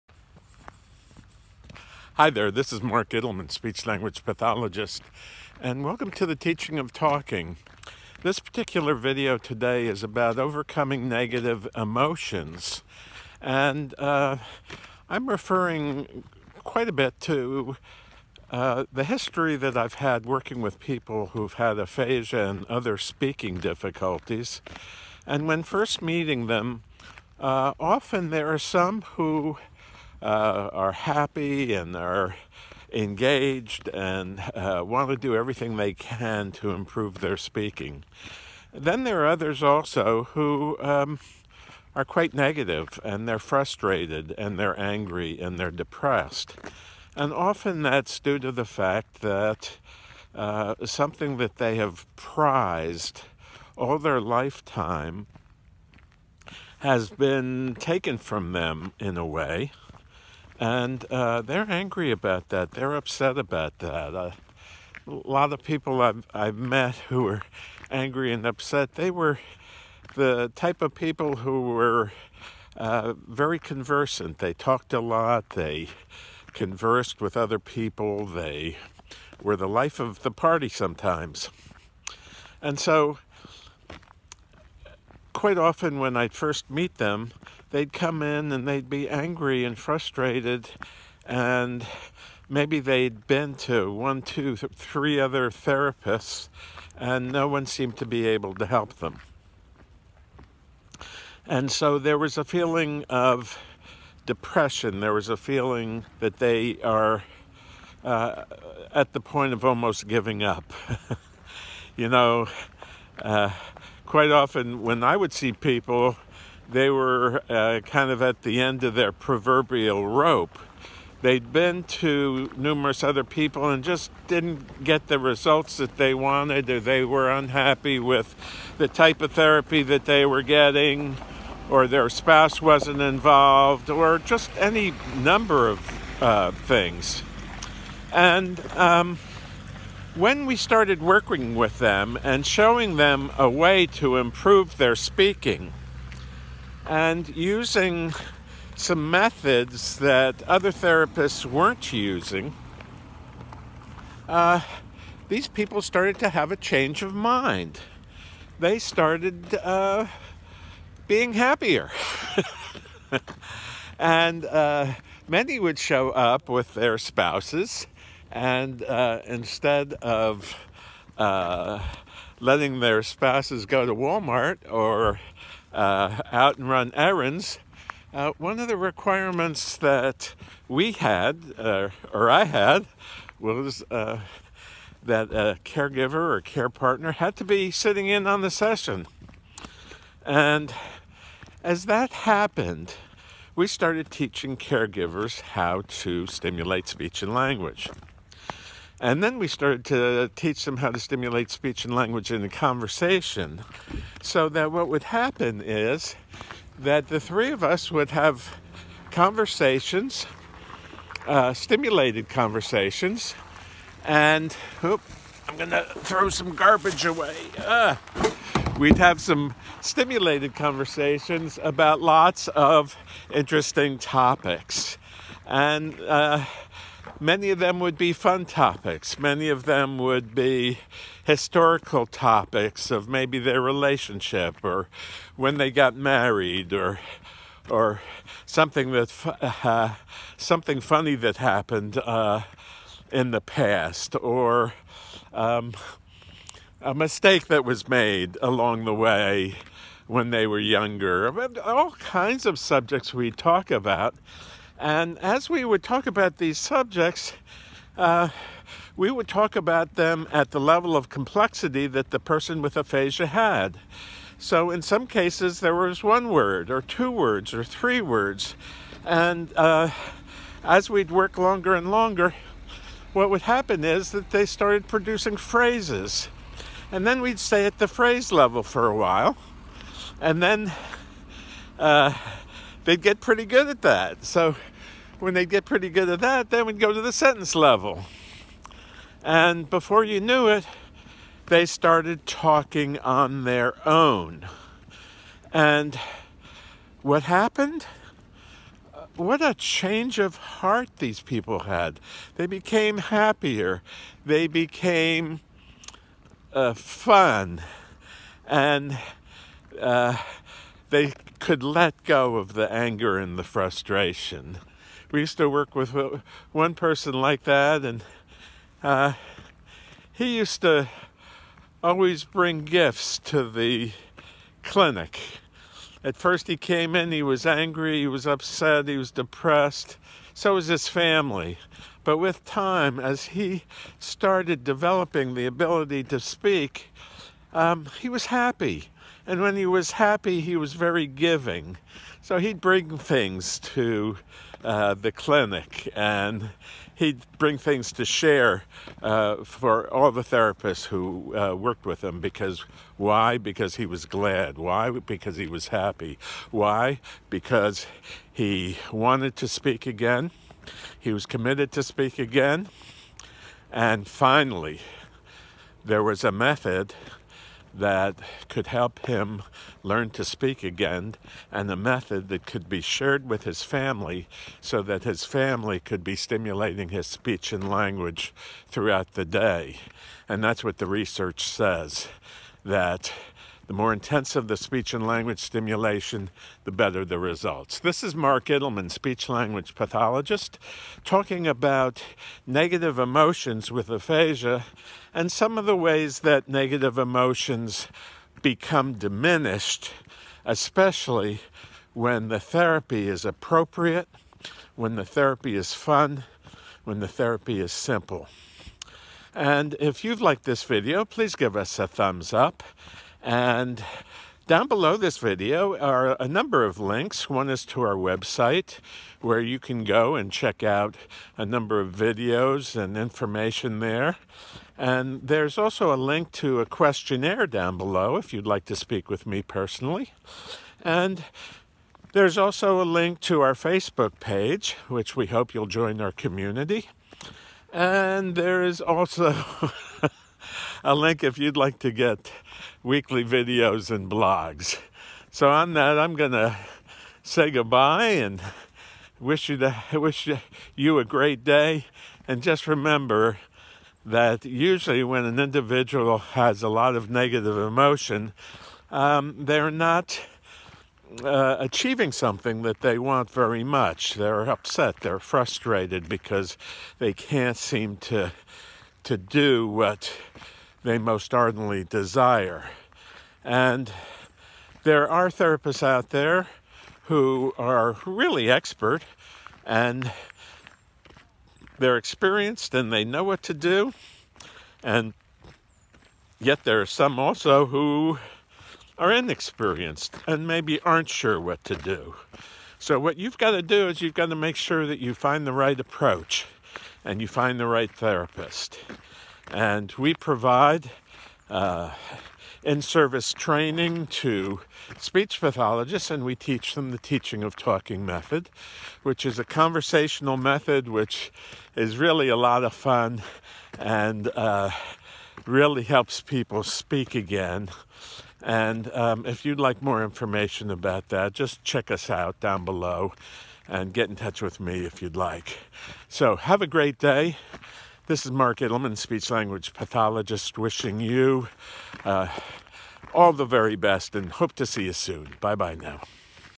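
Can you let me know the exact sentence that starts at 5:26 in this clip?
At first, he came in, he was angry, he was upset, he was depressed.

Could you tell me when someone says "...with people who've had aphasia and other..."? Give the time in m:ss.
0:20.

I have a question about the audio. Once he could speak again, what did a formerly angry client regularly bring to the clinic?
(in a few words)
gifts.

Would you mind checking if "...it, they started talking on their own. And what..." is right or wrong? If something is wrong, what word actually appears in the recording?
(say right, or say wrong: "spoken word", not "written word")
right.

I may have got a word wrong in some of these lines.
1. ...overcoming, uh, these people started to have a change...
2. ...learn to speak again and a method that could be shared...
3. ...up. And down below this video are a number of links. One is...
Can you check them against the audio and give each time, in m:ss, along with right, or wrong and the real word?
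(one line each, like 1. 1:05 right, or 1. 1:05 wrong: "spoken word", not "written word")
1. 2:31 wrong: "using", not "overcoming"
2. 6:09 right
3. 6:52 right.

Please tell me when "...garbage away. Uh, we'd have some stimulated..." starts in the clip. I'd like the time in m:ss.
3:36.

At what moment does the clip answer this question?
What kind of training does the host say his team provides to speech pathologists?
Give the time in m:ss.
8:22.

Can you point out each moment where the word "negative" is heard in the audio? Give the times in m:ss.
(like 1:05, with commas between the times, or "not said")
0:11, 0:42, 6:32, 6:36, 7:37.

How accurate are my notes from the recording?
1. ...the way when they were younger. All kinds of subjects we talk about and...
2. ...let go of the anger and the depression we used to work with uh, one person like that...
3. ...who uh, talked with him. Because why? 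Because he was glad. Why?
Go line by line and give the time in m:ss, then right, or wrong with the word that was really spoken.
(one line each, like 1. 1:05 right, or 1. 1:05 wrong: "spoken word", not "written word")
1. 4:08 right
2. 5:11 wrong: "frustration", not "depression"
3. 5:50 wrong: "worked", not "talked".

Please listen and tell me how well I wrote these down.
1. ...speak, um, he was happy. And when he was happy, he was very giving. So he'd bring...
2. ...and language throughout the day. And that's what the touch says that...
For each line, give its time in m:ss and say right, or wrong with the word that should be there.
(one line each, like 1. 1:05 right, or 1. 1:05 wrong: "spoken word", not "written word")
1. 5:36 right
2. 6:17 wrong: "research", not "touch".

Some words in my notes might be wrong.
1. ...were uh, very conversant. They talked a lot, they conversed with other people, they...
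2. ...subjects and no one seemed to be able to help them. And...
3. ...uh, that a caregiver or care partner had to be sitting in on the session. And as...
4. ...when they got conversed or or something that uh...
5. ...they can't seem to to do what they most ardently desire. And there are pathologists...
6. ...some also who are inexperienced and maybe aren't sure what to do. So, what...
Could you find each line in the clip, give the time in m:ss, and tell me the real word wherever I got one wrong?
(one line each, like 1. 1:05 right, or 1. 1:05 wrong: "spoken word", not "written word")
1. 1:11 right
2. 1:35 wrong: "therapists", not "subjects"
3. 3:03 right
4. 3:55 wrong: "married", not "conversed"
5. 7:46 wrong: "therapists", not "pathologists"
6. 8:06 right.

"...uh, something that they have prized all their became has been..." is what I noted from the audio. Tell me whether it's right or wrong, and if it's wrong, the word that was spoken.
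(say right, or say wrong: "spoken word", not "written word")
wrong: "lifetime", not "became".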